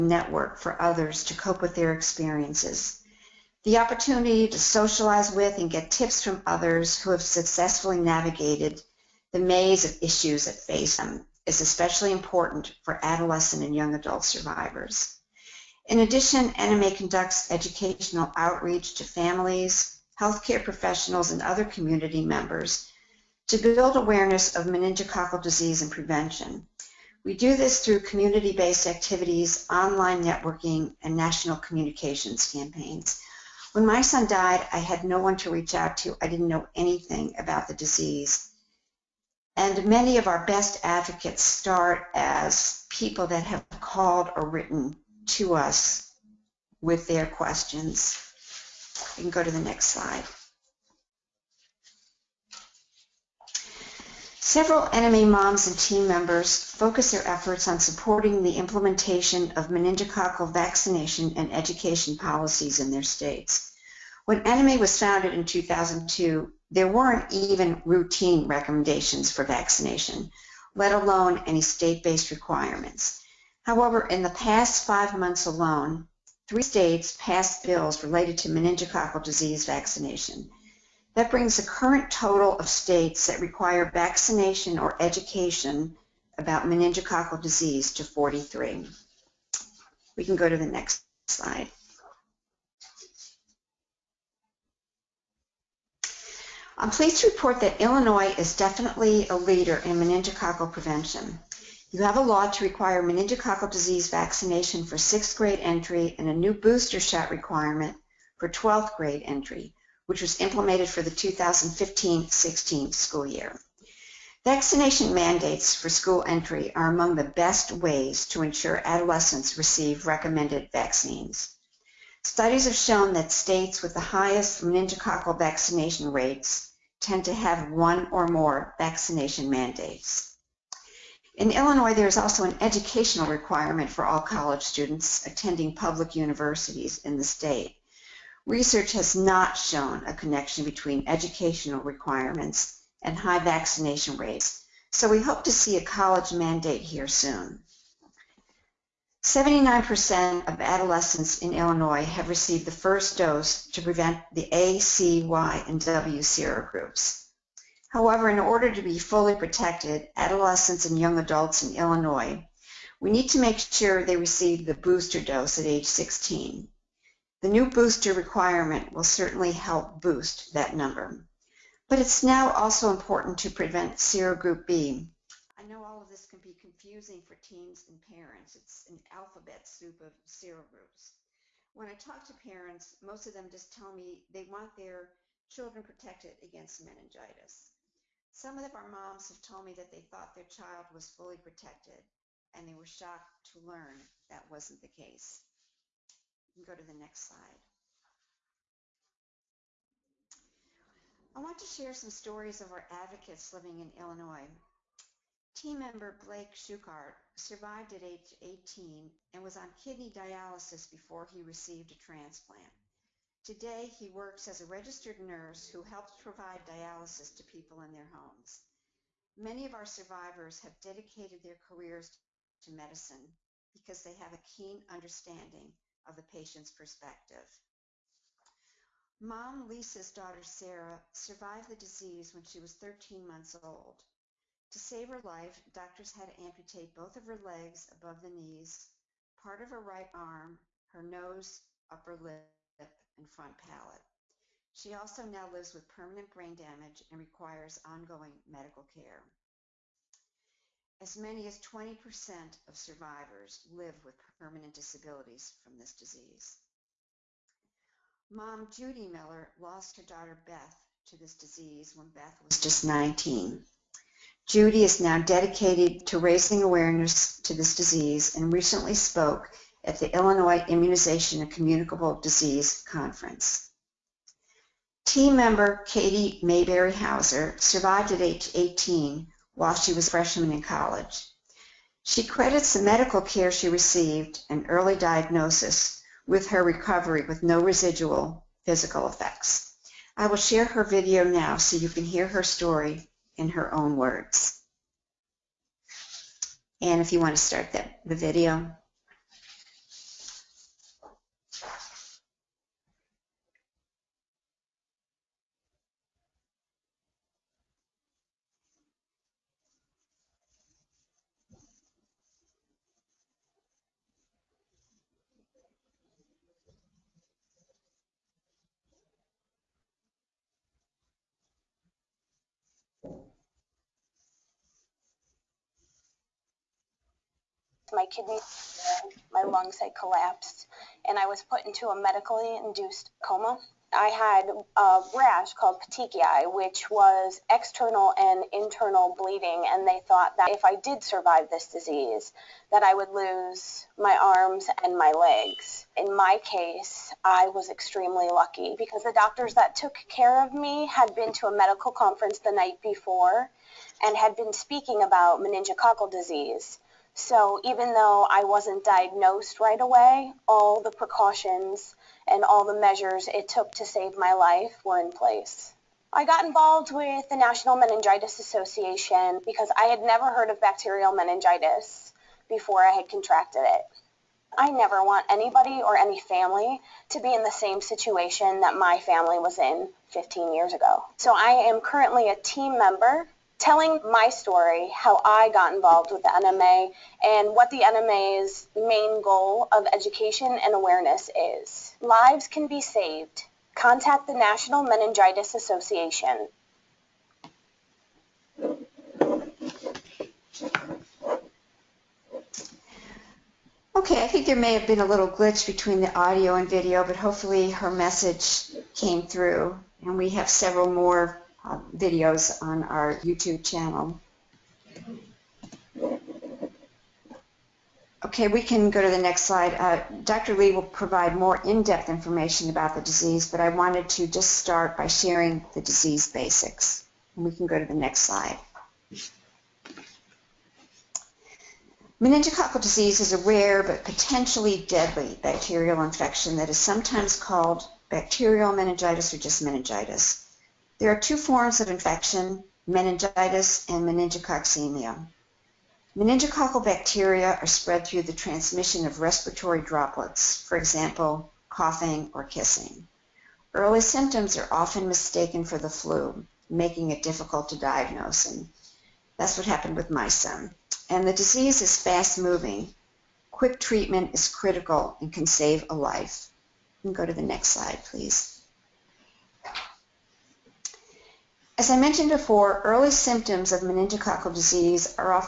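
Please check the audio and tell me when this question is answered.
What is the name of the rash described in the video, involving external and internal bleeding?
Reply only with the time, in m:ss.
5:35.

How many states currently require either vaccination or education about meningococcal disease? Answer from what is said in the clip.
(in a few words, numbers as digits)
43.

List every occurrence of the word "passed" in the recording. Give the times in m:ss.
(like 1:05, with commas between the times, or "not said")
1:17.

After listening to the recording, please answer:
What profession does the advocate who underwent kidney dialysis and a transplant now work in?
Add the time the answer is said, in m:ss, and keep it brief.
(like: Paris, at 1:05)
registered nurse, at 3:34.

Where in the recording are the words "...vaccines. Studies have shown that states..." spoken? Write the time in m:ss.
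2:00.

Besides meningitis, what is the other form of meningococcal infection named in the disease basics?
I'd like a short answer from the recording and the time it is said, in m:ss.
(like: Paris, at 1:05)
meningococcemia, at 7:24.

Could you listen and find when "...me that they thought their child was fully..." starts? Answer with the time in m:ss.
3:09.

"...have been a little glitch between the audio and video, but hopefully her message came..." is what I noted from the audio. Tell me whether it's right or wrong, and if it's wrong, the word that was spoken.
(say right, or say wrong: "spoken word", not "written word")
right.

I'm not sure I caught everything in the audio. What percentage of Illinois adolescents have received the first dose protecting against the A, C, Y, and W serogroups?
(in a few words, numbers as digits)
79%.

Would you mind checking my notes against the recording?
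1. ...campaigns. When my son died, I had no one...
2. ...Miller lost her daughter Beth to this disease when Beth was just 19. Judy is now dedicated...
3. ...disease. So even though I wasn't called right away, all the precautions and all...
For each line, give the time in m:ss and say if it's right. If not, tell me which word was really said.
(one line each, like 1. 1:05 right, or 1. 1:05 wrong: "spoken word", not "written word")
1. 0:32 right
2. 4:19 right
3. 5:56 wrong: "diagnosed", not "called".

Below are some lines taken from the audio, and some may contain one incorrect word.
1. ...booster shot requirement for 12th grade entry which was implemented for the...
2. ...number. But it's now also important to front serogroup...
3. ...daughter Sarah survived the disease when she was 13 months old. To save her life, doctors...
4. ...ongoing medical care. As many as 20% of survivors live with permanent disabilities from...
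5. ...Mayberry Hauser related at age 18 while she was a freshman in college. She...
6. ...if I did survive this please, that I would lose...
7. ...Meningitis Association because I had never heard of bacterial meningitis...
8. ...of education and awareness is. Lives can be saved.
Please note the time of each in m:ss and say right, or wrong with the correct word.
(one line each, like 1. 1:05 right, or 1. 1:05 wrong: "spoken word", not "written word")
1. 1:46 right
2. 2:50 wrong: "prevent", not "front"
3. 3:50 right
4. 4:07 right
5. 4:36 wrong: "survived", not "related"
6. 5:40 wrong: "disease", not "please"
7. 6:07 right
8. 6:29 right.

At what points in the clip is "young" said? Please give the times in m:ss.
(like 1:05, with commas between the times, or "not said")
0:13, 2:40.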